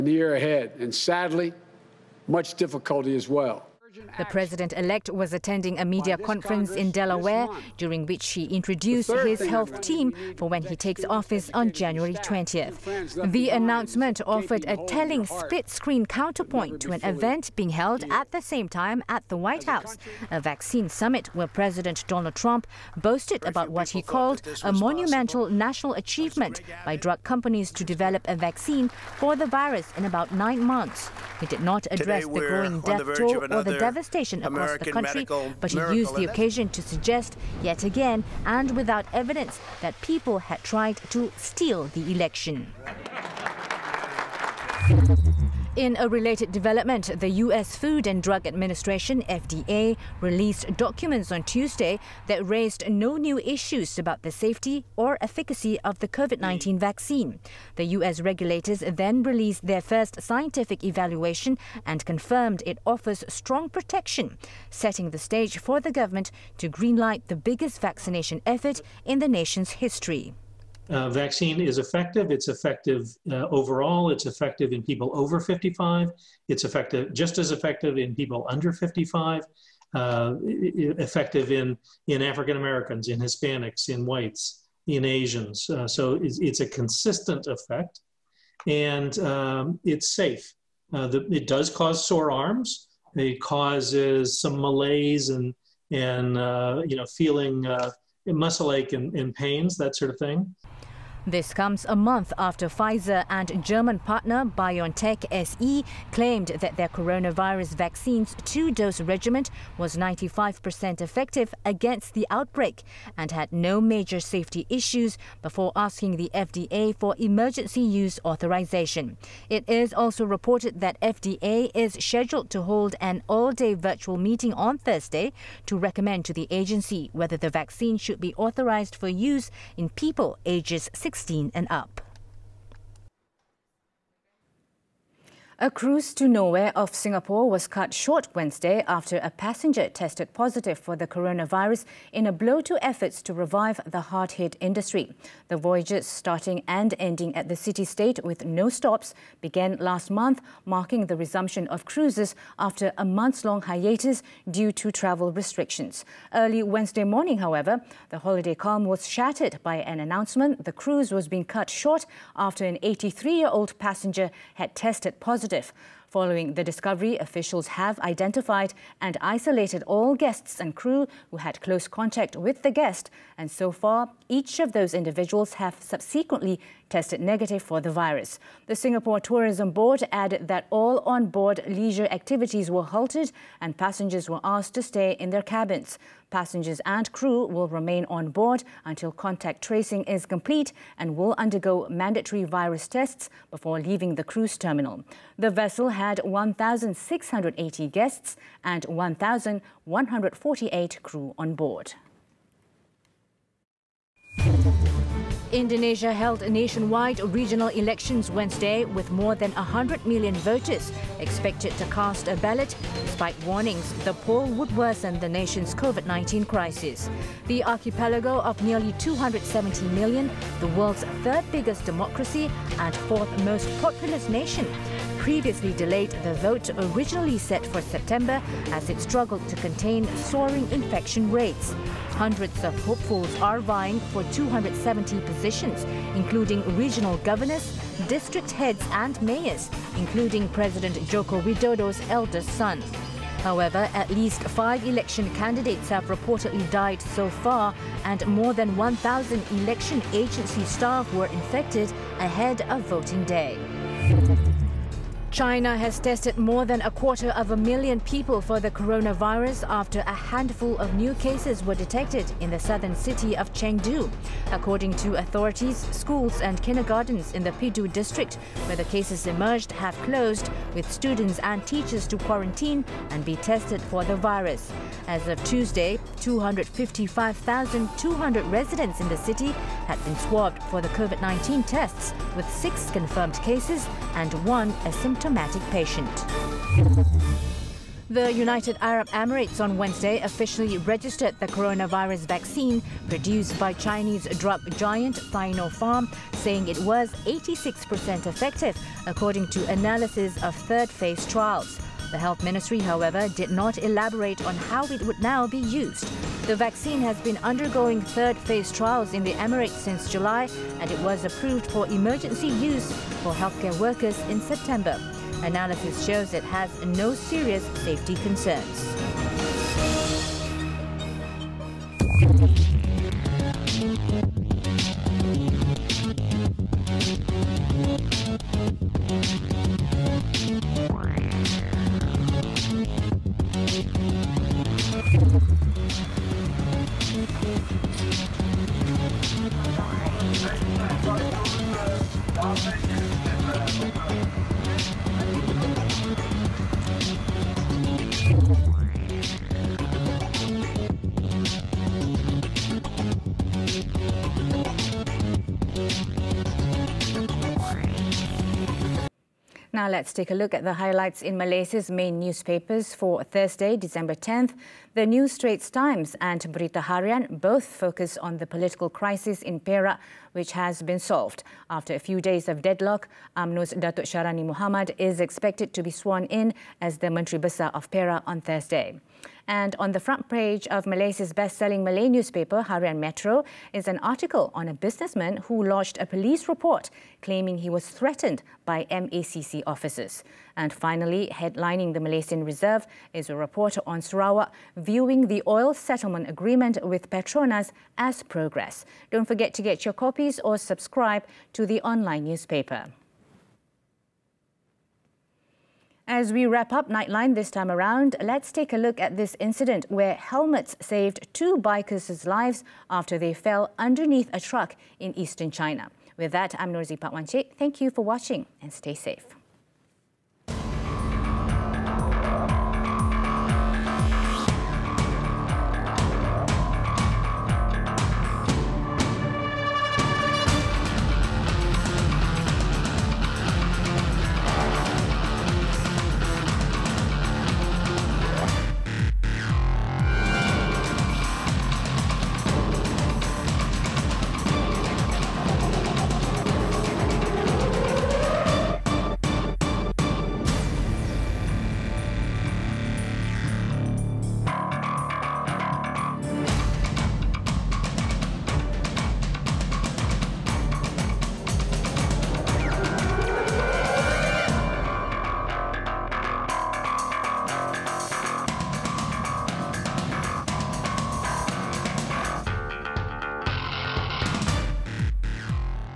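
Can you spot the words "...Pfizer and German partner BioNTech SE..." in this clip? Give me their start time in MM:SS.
01:42.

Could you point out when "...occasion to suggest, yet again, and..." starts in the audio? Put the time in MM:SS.
00:36.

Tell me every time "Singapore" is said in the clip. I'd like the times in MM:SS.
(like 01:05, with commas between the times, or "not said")
02:16, 02:58.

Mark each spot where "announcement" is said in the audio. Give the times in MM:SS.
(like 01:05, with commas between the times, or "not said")
00:13, 02:40.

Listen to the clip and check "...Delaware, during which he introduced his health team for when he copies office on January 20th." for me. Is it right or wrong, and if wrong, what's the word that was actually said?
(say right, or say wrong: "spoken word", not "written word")
wrong: "takes", not "copies".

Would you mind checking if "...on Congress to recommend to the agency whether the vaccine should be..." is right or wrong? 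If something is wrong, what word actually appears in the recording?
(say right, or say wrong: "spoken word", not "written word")
wrong: "Thursday", not "Congress".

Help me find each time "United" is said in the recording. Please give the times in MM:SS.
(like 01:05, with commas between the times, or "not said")
04:48.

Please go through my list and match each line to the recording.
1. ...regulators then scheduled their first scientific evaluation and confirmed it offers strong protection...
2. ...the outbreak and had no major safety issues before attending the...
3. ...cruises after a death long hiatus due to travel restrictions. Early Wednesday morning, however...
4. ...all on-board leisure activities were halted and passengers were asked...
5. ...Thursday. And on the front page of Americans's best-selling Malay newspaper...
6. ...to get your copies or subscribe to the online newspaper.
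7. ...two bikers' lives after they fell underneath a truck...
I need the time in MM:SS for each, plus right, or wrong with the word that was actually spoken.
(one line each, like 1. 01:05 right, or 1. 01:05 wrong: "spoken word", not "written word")
1. 00:58 wrong: "released", not "scheduled"
2. 01:52 wrong: "asking", not "attending"
3. 02:31 wrong: "month", not "death"
4. 03:00 right
5. 06:18 wrong: "Malaysia", not "Americans"
6. 06:39 right
7. 06:51 right.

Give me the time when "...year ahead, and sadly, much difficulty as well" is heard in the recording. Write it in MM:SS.
00:00.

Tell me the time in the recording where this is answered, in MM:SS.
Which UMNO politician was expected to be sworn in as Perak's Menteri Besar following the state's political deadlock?
06:13.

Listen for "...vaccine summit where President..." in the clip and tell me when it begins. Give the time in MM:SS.
00:20.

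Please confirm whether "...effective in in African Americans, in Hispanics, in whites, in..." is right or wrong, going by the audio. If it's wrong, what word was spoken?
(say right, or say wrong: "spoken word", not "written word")
right.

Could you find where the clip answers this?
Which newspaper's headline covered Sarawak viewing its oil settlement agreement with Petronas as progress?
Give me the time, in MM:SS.
06:32.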